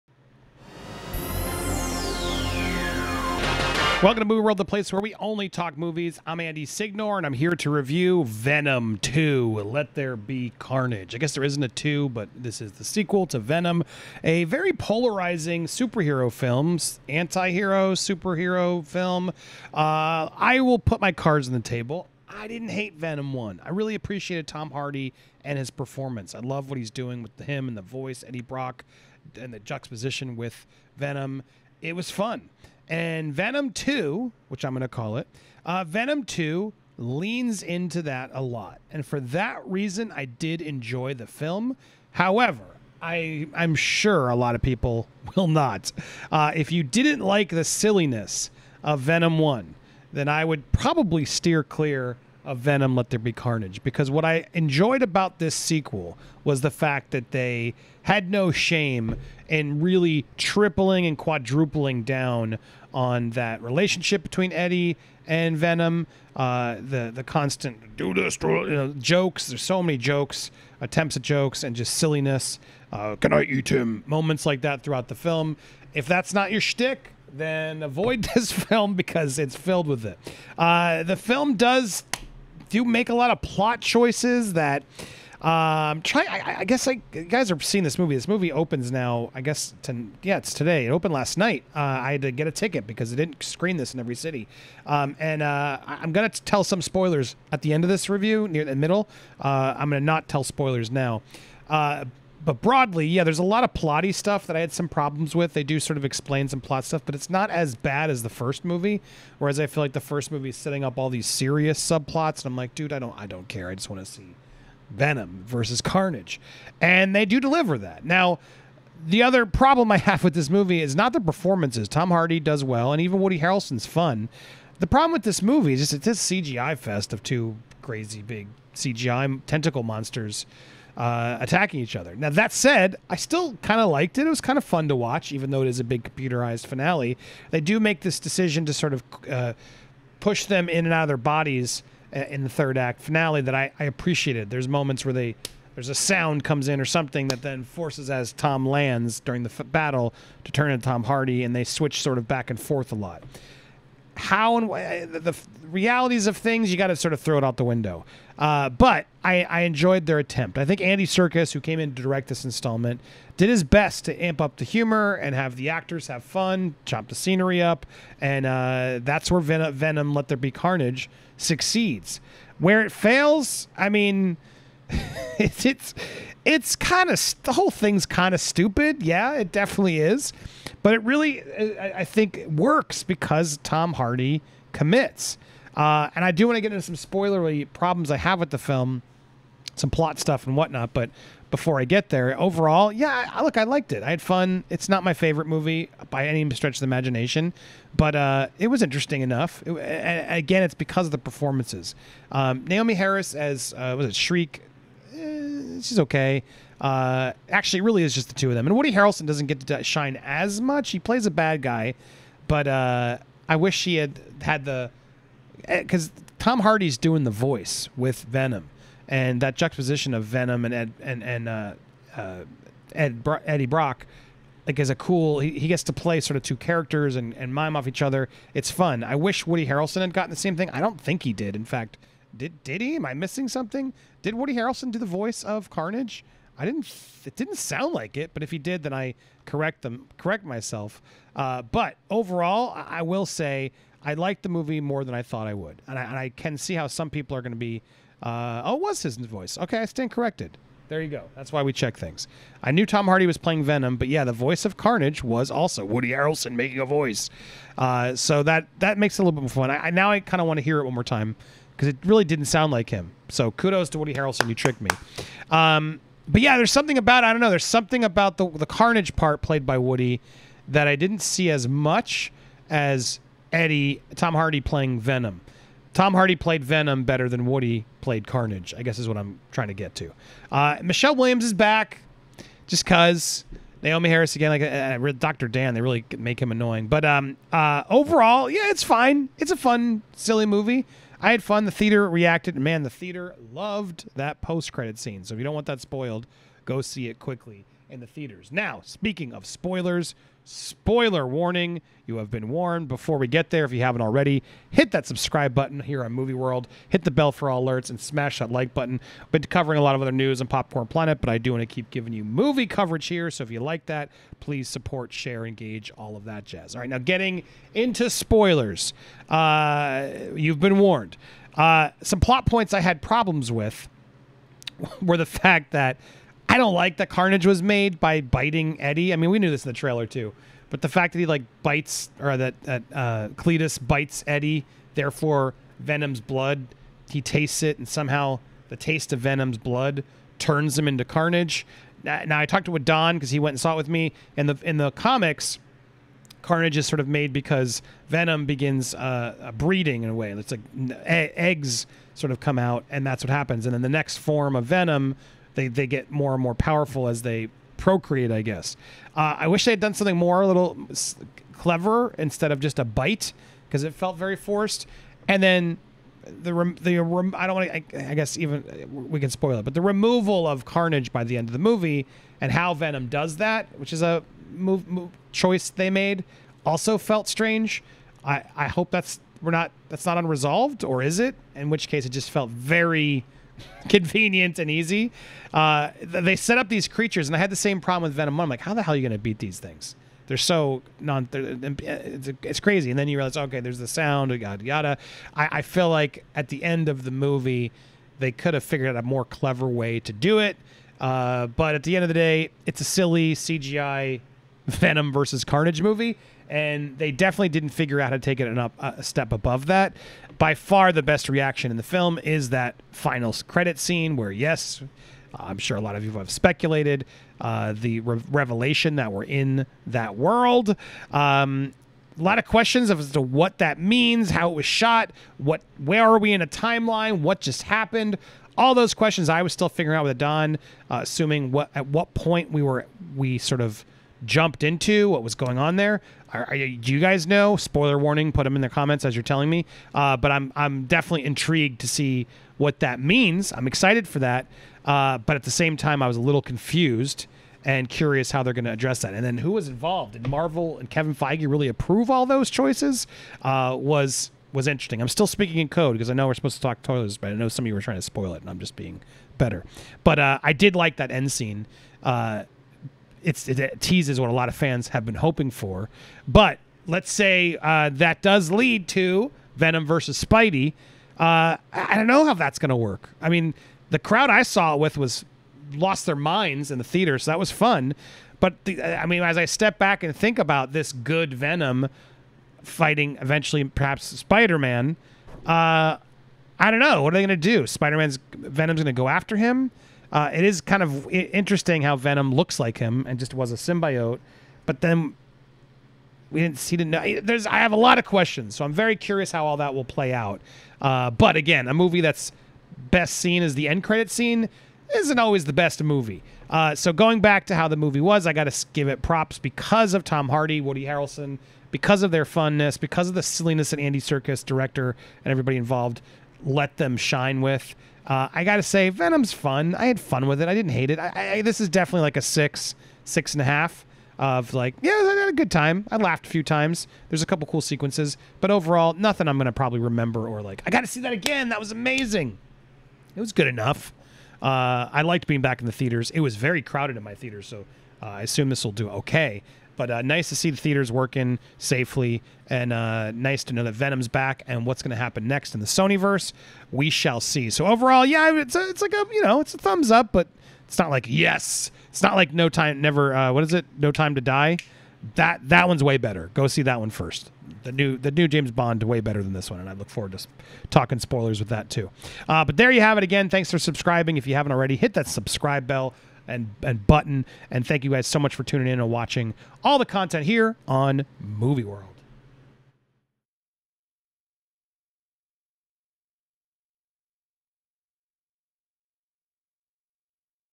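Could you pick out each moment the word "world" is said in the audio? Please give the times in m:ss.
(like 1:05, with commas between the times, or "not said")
0:04, 5:06, 7:00, 9:31.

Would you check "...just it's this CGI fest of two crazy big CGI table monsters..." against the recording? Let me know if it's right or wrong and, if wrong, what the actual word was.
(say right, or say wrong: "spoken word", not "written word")
wrong: "tentacle", not "table".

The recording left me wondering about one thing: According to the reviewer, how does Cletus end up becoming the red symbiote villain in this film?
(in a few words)
By biting Eddie.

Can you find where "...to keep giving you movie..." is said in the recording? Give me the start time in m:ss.
5:11.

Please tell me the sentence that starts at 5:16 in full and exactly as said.
All right, now getting into spoilers.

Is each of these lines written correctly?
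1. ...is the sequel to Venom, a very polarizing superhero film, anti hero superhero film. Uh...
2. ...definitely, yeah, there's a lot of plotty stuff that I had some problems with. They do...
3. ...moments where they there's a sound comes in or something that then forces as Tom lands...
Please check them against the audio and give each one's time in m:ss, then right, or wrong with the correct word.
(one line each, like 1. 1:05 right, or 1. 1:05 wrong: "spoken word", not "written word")
1. 0:12 right
2. 1:42 wrong: "broadly", not "definitely"
3. 2:24 right.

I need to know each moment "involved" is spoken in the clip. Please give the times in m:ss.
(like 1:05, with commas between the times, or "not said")
7:29, 8:35.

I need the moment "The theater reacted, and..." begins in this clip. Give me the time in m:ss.
4:51.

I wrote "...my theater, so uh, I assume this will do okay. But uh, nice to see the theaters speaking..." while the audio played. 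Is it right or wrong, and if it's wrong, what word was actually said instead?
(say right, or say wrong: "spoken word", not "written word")
wrong: "working", not "speaking".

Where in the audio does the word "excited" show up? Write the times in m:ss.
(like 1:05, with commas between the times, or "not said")
7:23.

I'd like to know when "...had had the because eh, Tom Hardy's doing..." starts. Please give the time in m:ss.
3:33.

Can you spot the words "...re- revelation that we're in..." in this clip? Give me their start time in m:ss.
6:58.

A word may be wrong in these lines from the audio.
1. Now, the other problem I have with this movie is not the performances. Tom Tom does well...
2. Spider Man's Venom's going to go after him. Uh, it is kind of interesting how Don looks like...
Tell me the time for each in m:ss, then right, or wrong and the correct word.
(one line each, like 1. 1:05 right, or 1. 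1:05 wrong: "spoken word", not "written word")
1. 1:58 wrong: "Hardy", not "Tom"
2. 8:07 wrong: "Venom", not "Don".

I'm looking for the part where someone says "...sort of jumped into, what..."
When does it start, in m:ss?
7:13.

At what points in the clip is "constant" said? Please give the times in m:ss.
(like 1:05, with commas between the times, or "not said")
1:07.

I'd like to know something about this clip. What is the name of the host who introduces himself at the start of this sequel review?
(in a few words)
Andy Signore.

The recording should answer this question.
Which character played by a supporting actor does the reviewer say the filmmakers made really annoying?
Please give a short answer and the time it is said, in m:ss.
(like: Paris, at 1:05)
Dr. Dan, at 4:45.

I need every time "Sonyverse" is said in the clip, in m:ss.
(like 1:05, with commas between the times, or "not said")
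9:05.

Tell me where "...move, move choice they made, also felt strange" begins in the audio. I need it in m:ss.
6:14.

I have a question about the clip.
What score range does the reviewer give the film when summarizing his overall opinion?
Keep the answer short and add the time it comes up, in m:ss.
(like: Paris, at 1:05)
6 to 6.5, at 8:42.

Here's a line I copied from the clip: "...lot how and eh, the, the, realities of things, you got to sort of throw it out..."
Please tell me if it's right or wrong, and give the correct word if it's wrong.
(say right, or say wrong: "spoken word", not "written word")
right.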